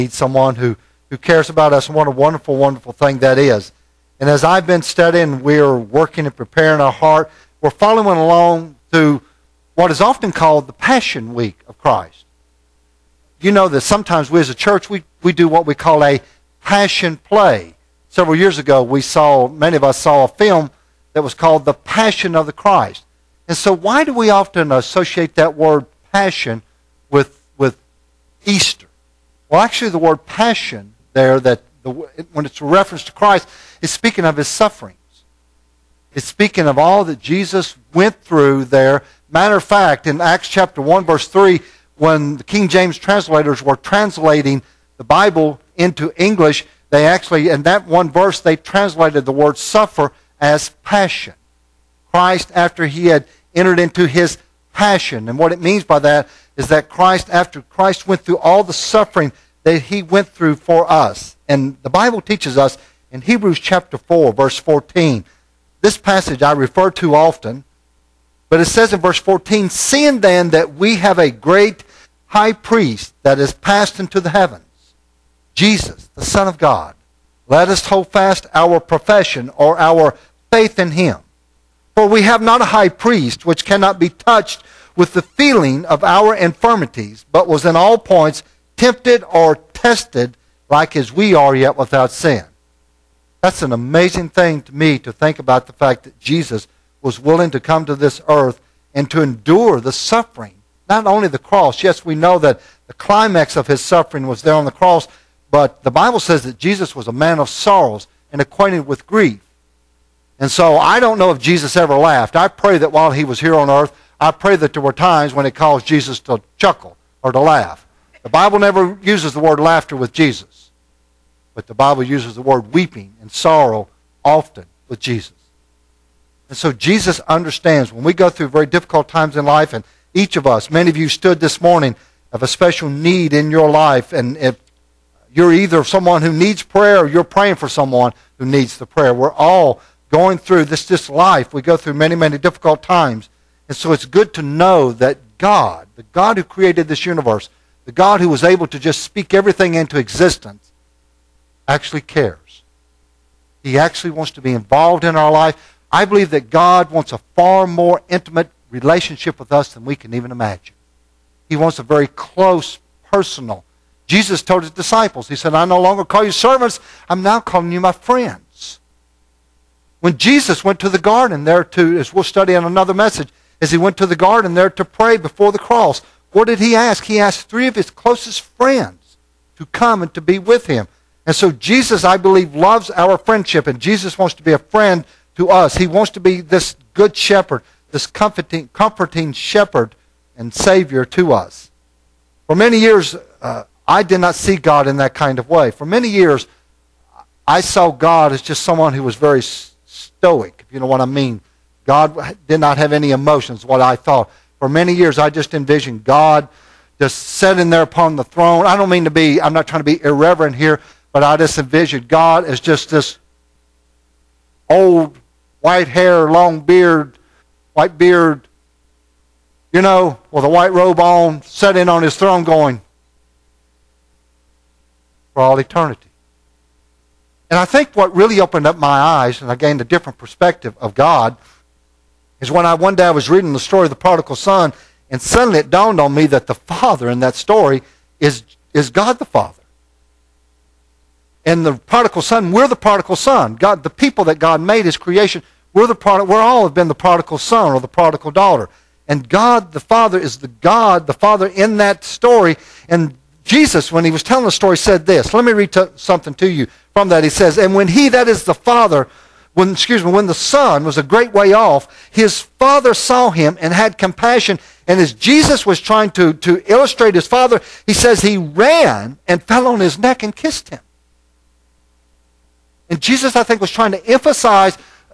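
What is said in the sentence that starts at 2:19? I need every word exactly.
We're all going through this, this life.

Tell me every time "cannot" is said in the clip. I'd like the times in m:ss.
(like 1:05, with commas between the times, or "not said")
1:23.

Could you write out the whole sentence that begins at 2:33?
He actually wants to be involved in our life.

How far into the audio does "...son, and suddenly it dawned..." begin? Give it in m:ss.
3:54.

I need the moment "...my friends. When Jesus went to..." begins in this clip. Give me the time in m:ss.
2:47.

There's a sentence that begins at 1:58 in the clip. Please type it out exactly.
The Bible never uses the word laughter with Jesus.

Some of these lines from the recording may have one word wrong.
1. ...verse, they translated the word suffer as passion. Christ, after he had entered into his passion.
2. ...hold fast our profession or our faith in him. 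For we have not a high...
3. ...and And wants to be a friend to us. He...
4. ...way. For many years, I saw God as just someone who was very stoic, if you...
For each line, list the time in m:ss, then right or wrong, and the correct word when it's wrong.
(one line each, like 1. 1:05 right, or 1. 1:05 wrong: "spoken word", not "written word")
1. 0:48 right
2. 1:17 right
3. 3:03 wrong: "Jesus", not "And"
4. 3:15 right.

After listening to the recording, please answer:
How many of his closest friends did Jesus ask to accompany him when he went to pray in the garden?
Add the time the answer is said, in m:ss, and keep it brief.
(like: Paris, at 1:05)
3, at 2:57.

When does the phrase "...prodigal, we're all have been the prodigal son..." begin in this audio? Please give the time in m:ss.
4:05.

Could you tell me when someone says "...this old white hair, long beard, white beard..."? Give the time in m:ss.
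3:32.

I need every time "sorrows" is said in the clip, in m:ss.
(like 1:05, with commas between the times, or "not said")
1:47, 2:03.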